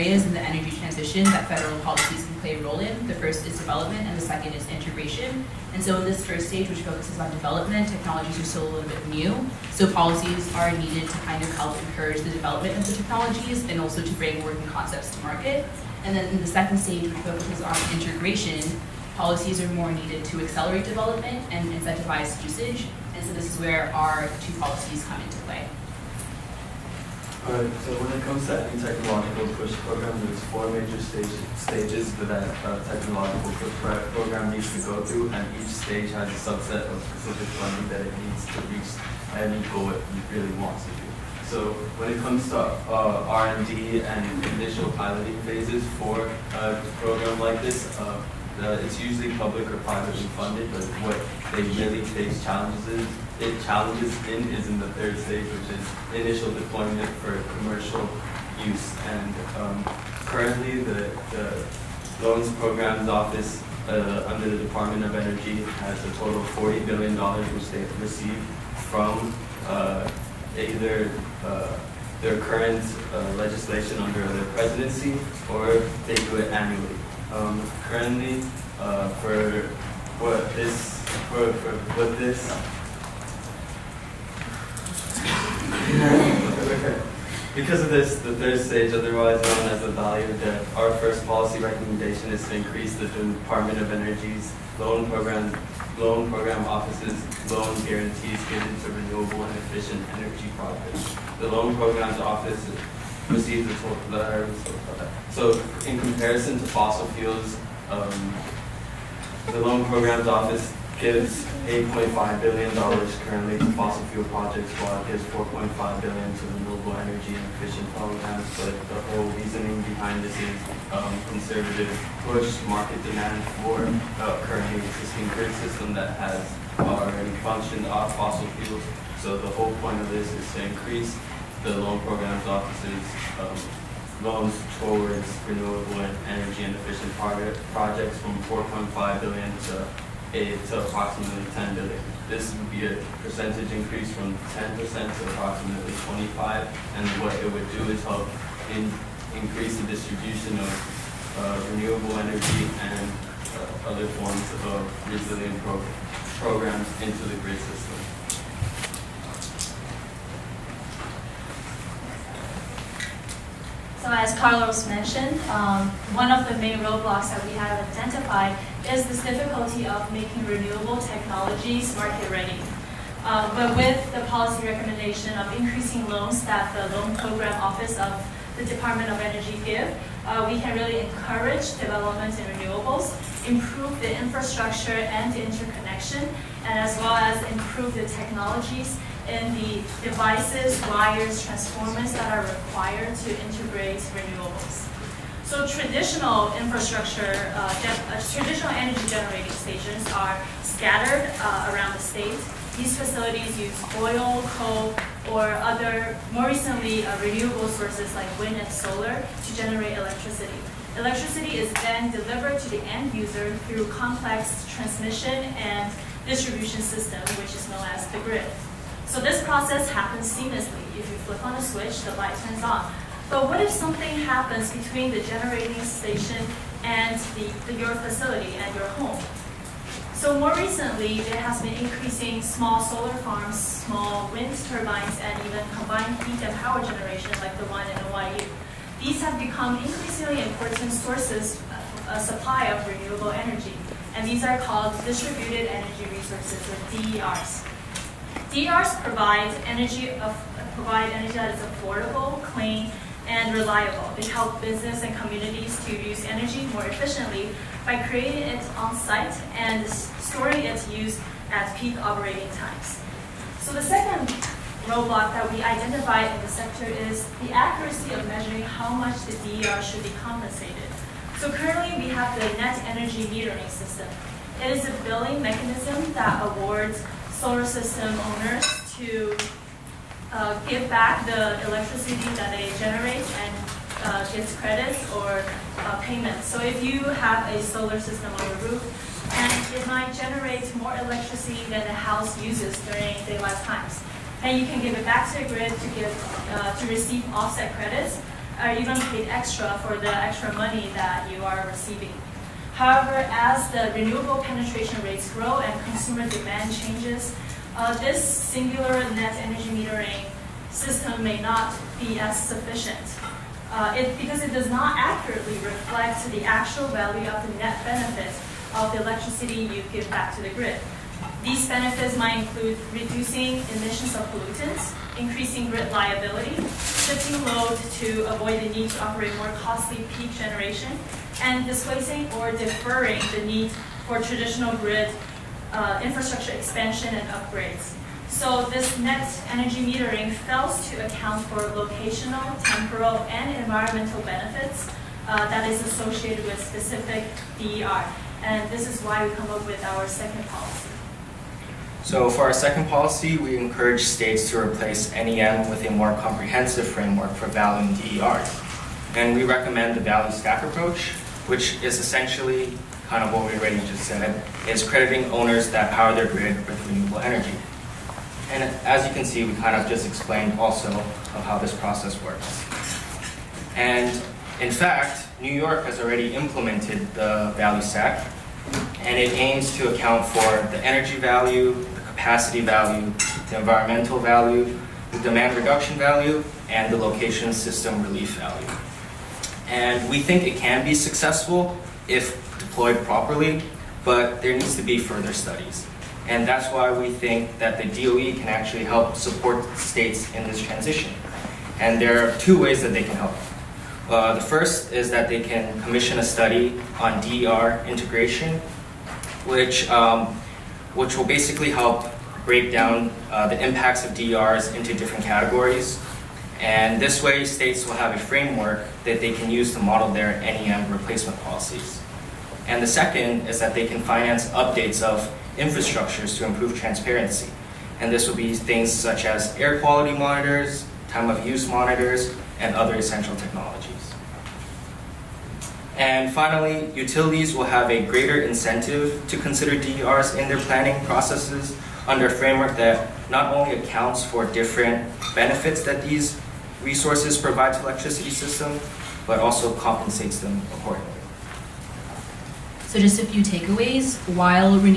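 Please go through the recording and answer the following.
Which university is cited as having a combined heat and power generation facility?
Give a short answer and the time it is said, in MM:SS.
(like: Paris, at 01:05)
NYU, at 03:58.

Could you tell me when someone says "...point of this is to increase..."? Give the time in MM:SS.
02:09.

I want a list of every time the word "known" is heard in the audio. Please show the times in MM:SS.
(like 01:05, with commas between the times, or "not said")
01:29, 03:37.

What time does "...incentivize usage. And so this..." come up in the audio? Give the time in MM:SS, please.
00:21.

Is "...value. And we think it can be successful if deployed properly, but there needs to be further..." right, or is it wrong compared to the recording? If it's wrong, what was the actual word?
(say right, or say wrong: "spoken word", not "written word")
right.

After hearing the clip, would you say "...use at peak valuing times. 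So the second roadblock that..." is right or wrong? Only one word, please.
wrong.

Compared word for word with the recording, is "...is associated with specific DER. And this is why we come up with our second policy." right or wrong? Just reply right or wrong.
right.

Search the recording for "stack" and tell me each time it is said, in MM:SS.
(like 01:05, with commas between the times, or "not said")
06:00, 06:17.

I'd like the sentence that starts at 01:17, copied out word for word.
Um, currently, uh, for what this, for, for what this.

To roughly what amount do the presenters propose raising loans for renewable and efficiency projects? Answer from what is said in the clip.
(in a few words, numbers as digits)
$10 billion.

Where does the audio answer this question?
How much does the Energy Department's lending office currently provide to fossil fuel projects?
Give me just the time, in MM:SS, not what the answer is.
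01:51.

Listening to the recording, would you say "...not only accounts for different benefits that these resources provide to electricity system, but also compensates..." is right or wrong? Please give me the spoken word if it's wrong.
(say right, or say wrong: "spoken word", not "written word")
right.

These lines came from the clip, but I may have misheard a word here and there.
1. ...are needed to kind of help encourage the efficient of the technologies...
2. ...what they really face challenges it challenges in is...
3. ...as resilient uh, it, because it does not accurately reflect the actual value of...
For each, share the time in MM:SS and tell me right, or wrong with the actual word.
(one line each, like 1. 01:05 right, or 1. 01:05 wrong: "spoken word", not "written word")
1. 00:10 wrong: "development", not "efficient"
2. 00:51 right
3. 05:12 wrong: "sufficient", not "resilient".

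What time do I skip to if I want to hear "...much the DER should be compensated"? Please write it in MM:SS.
04:28.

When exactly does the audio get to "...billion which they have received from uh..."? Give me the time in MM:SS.
01:06.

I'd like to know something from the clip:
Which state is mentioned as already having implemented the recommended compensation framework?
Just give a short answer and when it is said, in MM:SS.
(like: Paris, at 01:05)
New York, at 06:15.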